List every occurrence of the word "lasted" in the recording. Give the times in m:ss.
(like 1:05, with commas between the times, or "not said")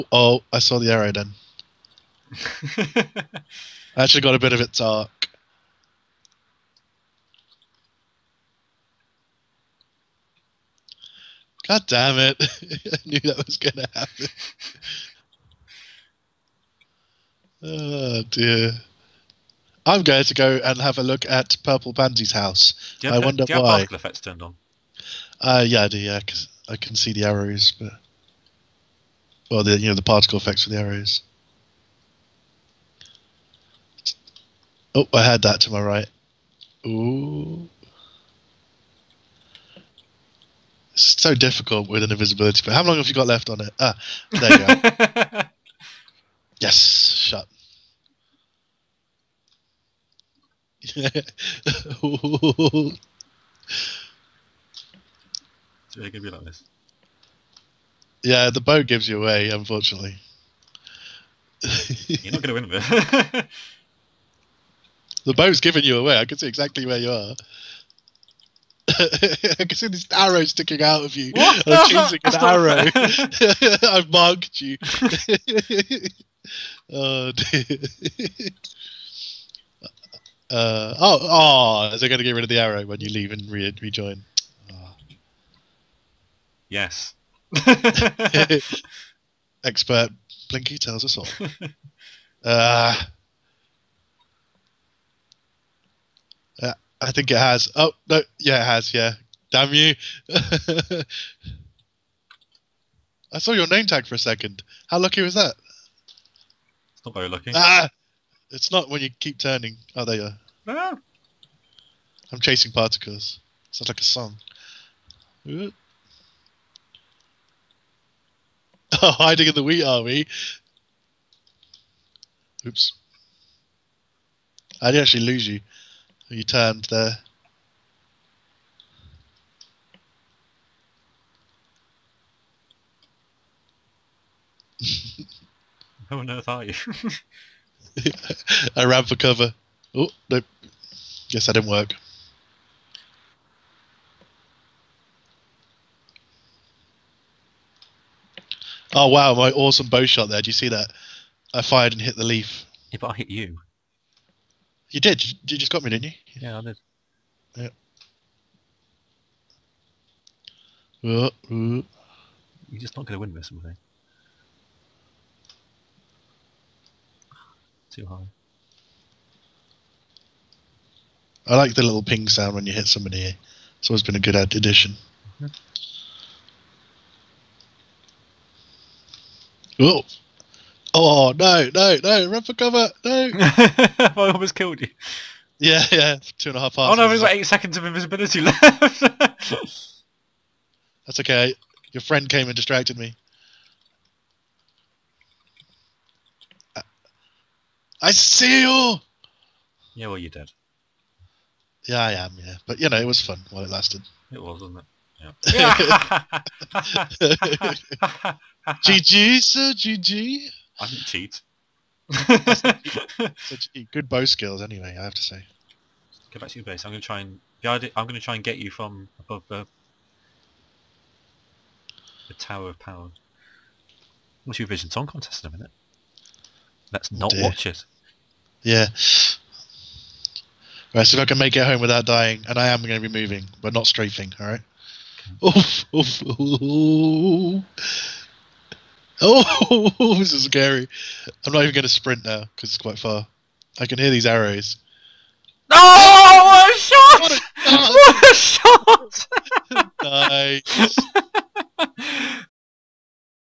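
3:23.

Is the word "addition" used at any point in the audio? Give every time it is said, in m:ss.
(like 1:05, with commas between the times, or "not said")
2:54.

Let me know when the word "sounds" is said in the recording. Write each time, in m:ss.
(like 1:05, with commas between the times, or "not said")
1:53, 2:52.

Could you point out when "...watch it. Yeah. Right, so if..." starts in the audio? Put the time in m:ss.
3:47.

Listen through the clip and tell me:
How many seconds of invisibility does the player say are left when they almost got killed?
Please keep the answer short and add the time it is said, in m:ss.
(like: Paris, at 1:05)
8, at 3:07.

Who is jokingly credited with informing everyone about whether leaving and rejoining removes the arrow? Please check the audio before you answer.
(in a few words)
Expert Blinky.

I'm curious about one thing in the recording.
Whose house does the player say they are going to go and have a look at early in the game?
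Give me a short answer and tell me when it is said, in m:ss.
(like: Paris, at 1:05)
Purple Pansy's, at 0:21.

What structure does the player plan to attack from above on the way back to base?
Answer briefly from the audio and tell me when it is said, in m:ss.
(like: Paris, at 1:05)
The Tower of Power, at 3:42.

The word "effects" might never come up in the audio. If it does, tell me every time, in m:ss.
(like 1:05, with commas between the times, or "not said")
0:23, 0:30.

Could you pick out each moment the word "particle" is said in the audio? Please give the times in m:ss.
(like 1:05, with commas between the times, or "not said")
0:30, 1:52.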